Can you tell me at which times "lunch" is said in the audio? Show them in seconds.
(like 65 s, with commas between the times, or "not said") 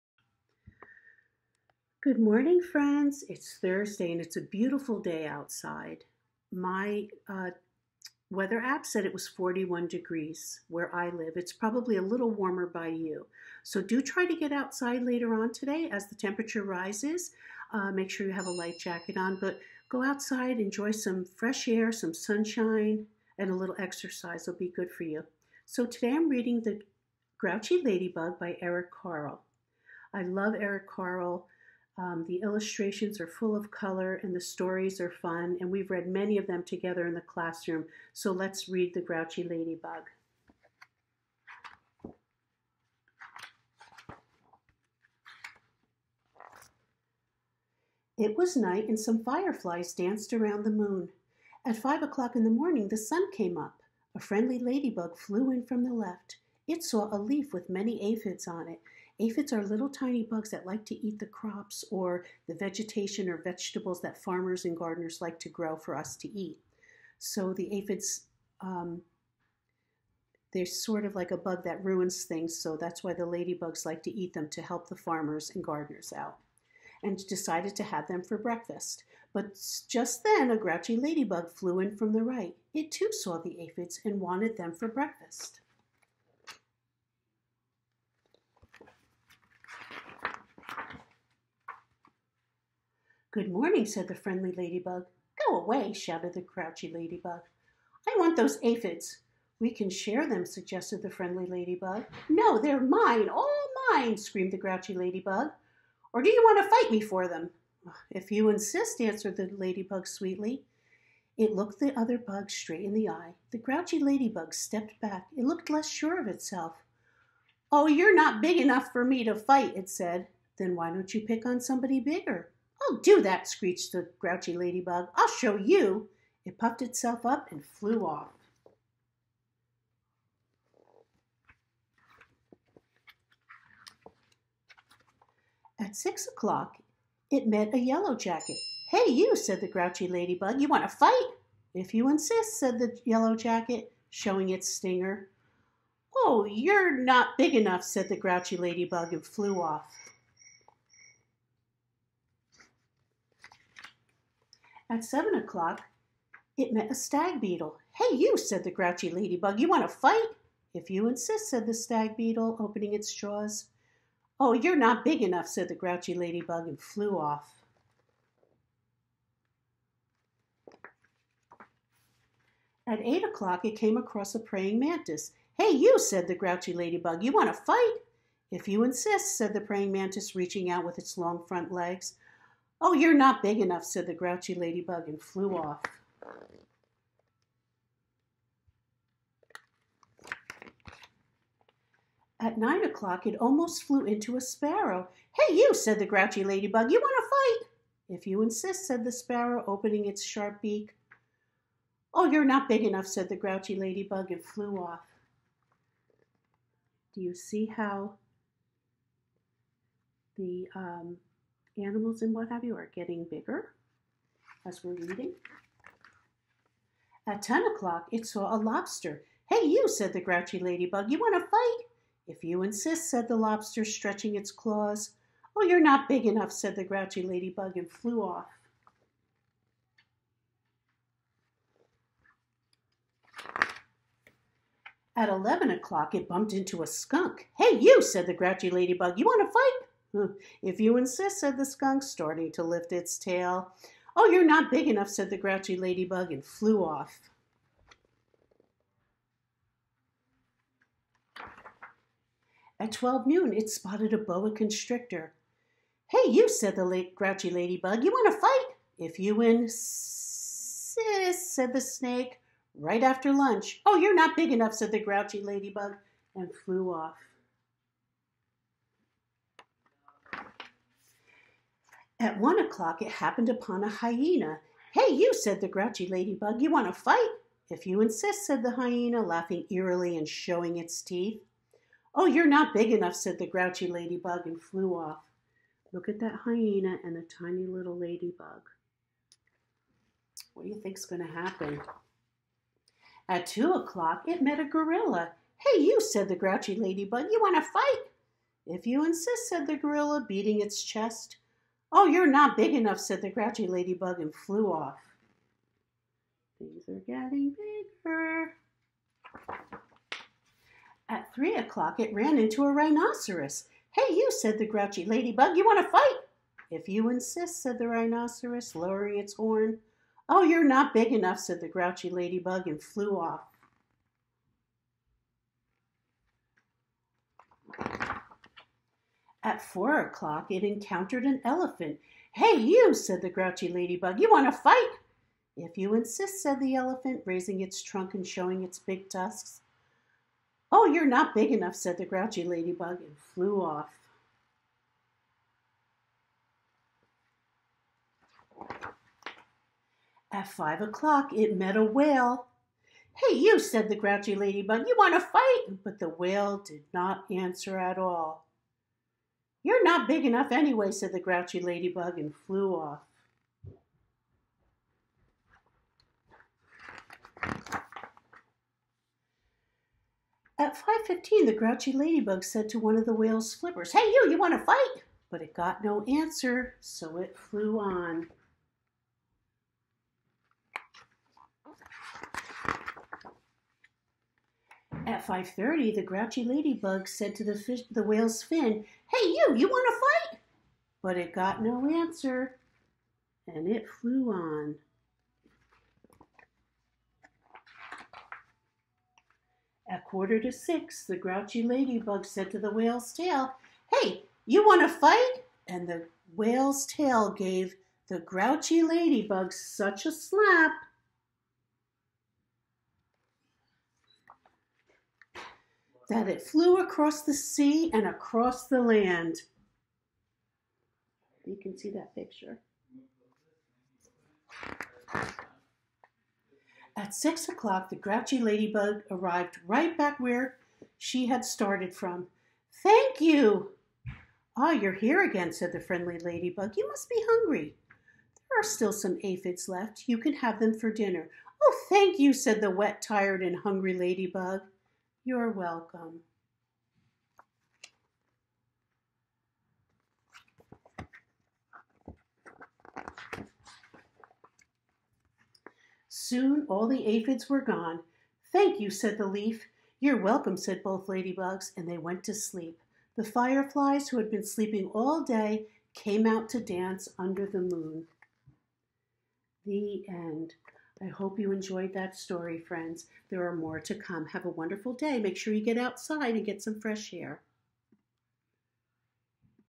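263 s.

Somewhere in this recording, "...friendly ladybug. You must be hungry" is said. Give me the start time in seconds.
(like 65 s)
435 s.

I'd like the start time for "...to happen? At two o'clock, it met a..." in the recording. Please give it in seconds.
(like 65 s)
291 s.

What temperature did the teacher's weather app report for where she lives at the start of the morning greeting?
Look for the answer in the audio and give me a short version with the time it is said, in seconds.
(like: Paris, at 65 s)
41 degrees, at 9 s.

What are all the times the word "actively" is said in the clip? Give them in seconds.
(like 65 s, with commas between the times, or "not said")
not said.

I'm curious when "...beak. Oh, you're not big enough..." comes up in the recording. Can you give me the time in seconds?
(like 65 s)
200 s.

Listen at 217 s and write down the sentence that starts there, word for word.
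At 10 o'clock, it saw a lobster.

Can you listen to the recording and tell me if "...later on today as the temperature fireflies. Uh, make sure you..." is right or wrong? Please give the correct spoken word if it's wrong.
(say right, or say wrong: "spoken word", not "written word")
wrong: "rises", not "fireflies".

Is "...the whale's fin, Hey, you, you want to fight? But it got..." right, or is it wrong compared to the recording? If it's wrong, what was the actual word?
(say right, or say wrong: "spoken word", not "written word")
right.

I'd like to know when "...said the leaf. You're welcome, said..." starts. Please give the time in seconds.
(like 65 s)
458 s.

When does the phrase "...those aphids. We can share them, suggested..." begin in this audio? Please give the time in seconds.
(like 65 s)
98 s.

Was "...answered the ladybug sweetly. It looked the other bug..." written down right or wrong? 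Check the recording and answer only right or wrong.
right.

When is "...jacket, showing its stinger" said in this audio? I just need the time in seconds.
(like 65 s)
143 s.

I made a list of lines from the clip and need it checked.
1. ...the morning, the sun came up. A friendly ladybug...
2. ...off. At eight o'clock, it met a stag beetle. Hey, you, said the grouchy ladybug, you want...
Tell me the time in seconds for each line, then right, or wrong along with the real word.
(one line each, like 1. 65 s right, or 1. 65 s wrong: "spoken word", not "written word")
1. 52 s right
2. 149 s wrong: "seven", not "eight".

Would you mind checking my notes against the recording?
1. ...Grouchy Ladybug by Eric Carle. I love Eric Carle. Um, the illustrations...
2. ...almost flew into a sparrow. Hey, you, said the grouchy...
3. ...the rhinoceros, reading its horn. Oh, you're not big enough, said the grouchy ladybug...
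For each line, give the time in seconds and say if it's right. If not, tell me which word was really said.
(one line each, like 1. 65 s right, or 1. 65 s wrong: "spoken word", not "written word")
1. 27 s right
2. 193 s right
3. 317 s wrong: "lowering", not "reading".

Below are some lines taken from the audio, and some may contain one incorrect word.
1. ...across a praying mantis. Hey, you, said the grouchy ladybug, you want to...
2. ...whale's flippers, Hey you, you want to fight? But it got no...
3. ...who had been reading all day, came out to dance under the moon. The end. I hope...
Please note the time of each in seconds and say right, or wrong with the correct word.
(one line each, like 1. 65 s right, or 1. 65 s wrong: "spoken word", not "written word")
1. 173 s right
2. 373 s right
3. 464 s wrong: "sleeping", not "reading".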